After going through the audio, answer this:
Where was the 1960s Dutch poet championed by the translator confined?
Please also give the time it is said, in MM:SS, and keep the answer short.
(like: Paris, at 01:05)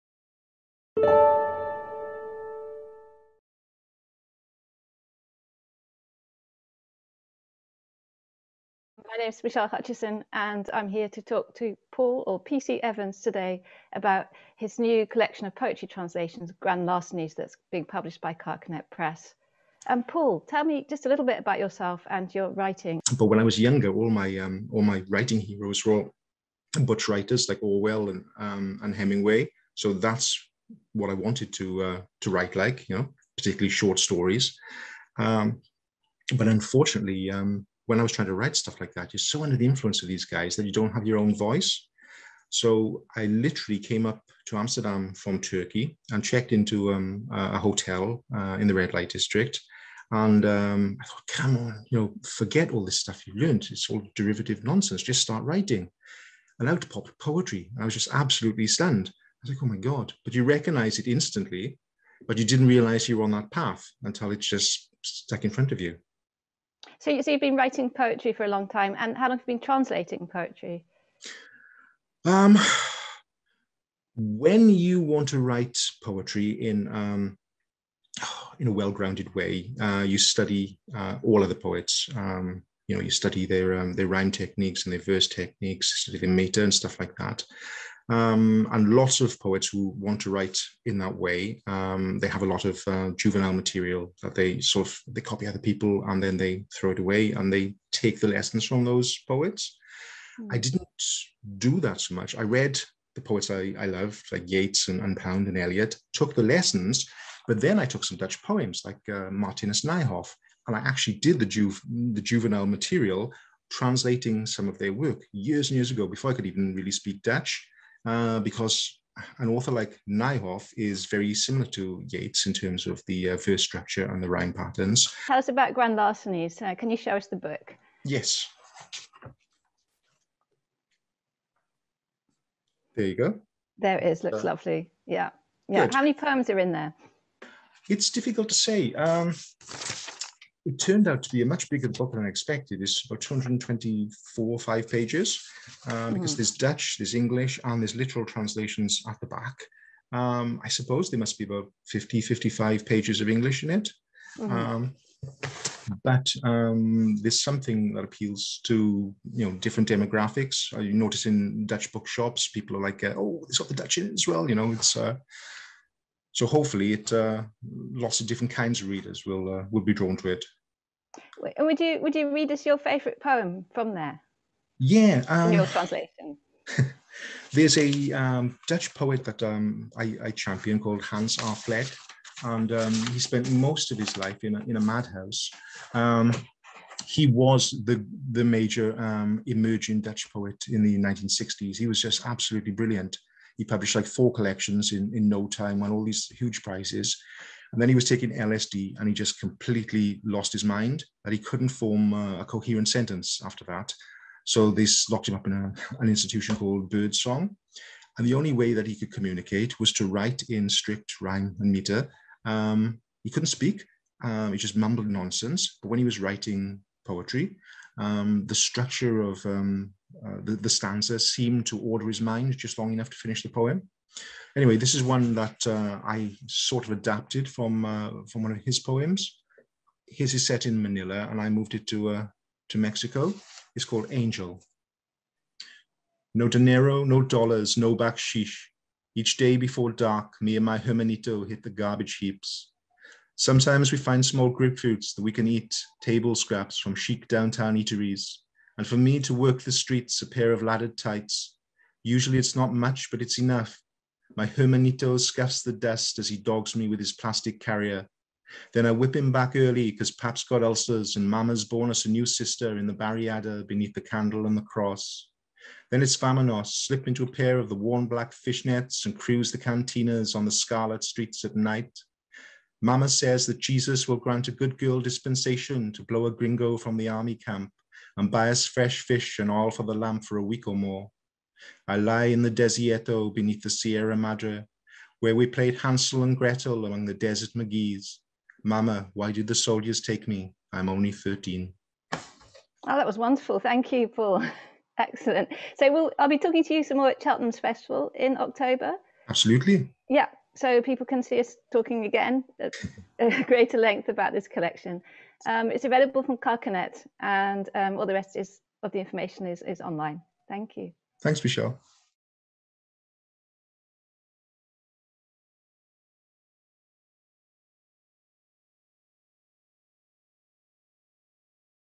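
Birdsong, at 03:26.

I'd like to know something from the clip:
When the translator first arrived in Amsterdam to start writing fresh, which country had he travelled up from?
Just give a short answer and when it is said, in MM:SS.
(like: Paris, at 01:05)
Turkey, at 00:45.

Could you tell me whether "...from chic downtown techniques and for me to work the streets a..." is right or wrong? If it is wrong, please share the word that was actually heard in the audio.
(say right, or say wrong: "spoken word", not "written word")
wrong: "eateries", not "techniques".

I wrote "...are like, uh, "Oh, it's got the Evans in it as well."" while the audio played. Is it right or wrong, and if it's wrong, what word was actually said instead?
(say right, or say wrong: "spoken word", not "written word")
wrong: "Dutch", not "Evans".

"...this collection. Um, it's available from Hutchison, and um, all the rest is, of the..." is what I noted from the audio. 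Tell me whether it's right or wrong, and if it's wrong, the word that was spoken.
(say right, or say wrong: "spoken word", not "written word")
wrong: "Carcanet", not "Hutchison".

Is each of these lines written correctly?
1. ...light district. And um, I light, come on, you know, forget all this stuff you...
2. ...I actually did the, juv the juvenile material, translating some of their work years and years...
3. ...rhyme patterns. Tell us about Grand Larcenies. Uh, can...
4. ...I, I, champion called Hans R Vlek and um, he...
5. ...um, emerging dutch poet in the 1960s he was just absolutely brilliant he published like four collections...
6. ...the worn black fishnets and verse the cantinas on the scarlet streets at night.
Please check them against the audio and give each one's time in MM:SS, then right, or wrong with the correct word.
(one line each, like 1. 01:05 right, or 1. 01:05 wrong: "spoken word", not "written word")
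1. 00:48 wrong: "thought", not "light"
2. 01:50 right
3. 02:04 right
4. 02:59 right
5. 03:09 right
6. 04:27 wrong: "cruise", not "verse".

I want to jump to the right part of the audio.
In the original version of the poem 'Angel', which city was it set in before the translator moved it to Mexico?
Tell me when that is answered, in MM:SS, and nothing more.
03:50.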